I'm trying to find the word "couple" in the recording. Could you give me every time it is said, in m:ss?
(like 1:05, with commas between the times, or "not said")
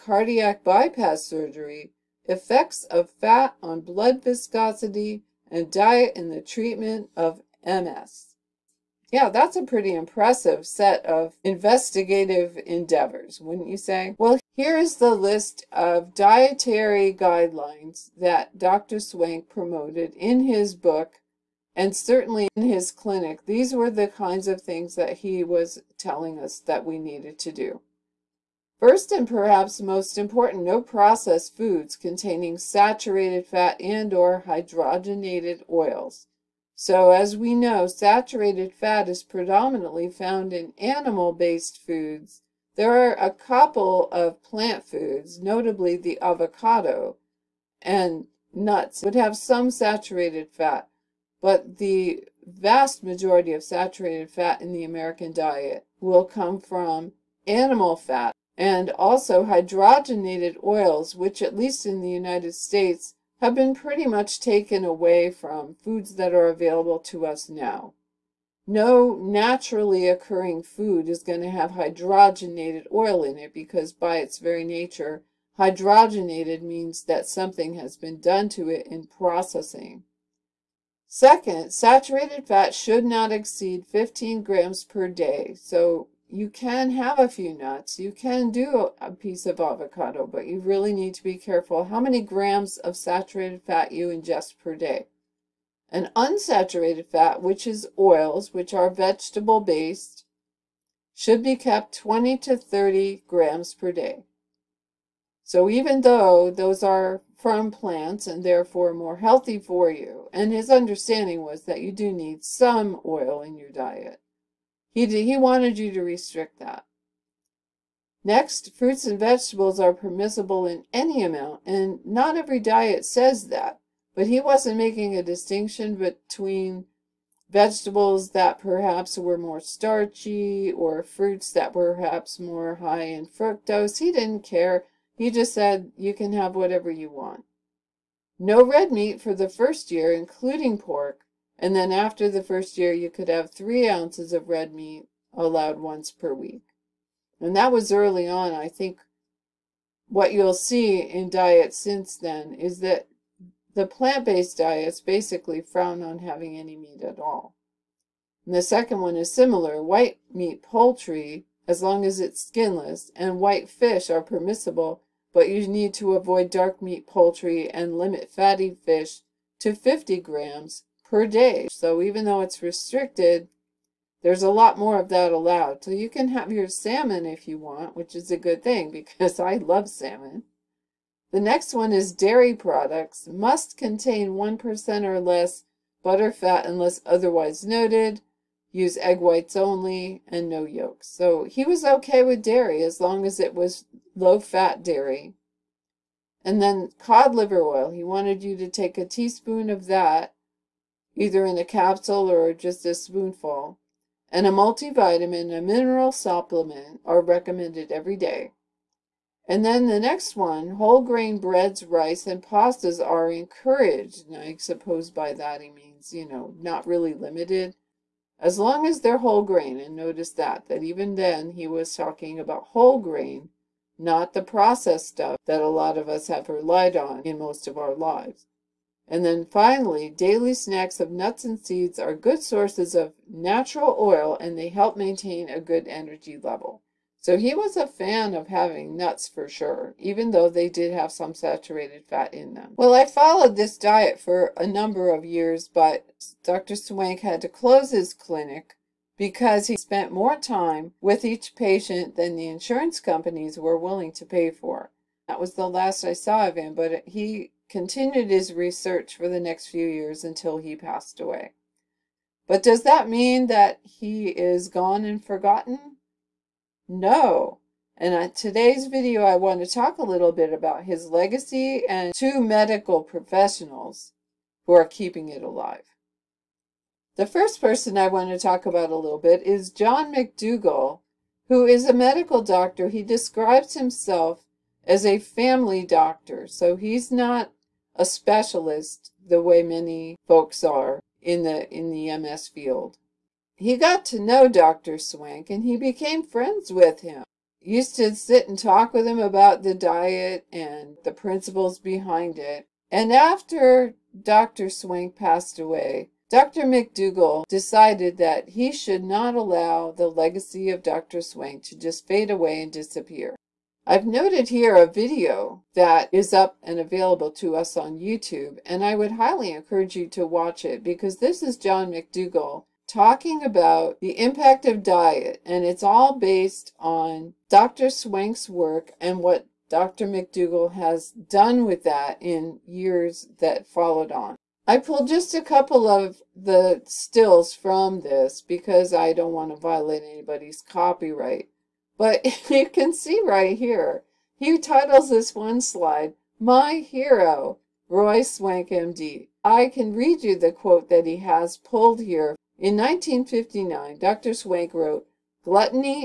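0:43, 5:35.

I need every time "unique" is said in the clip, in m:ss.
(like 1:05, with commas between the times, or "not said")
not said.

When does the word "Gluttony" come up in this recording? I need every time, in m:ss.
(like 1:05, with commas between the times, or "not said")
5:55.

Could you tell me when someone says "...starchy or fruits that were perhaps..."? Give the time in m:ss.
2:09.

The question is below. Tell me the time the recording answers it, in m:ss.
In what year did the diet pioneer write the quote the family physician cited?
5:52.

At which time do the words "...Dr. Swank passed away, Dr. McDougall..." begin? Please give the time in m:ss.
5:04.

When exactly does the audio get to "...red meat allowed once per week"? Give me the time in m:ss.
2:24.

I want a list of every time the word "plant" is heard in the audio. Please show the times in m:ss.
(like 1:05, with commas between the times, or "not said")
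0:44, 1:47, 2:33.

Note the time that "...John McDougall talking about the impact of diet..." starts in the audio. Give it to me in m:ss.
5:21.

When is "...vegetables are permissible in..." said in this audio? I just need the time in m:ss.
1:59.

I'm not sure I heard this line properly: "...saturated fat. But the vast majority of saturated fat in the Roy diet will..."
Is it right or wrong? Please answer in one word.
wrong.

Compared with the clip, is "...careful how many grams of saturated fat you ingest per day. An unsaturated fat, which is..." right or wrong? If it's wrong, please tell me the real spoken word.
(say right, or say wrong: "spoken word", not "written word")
right.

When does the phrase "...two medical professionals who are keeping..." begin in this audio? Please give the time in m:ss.
4:32.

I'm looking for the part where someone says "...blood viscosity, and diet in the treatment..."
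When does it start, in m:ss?
0:03.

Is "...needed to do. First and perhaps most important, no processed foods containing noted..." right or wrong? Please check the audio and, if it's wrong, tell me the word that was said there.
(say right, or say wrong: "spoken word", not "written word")
wrong: "saturated", not "noted".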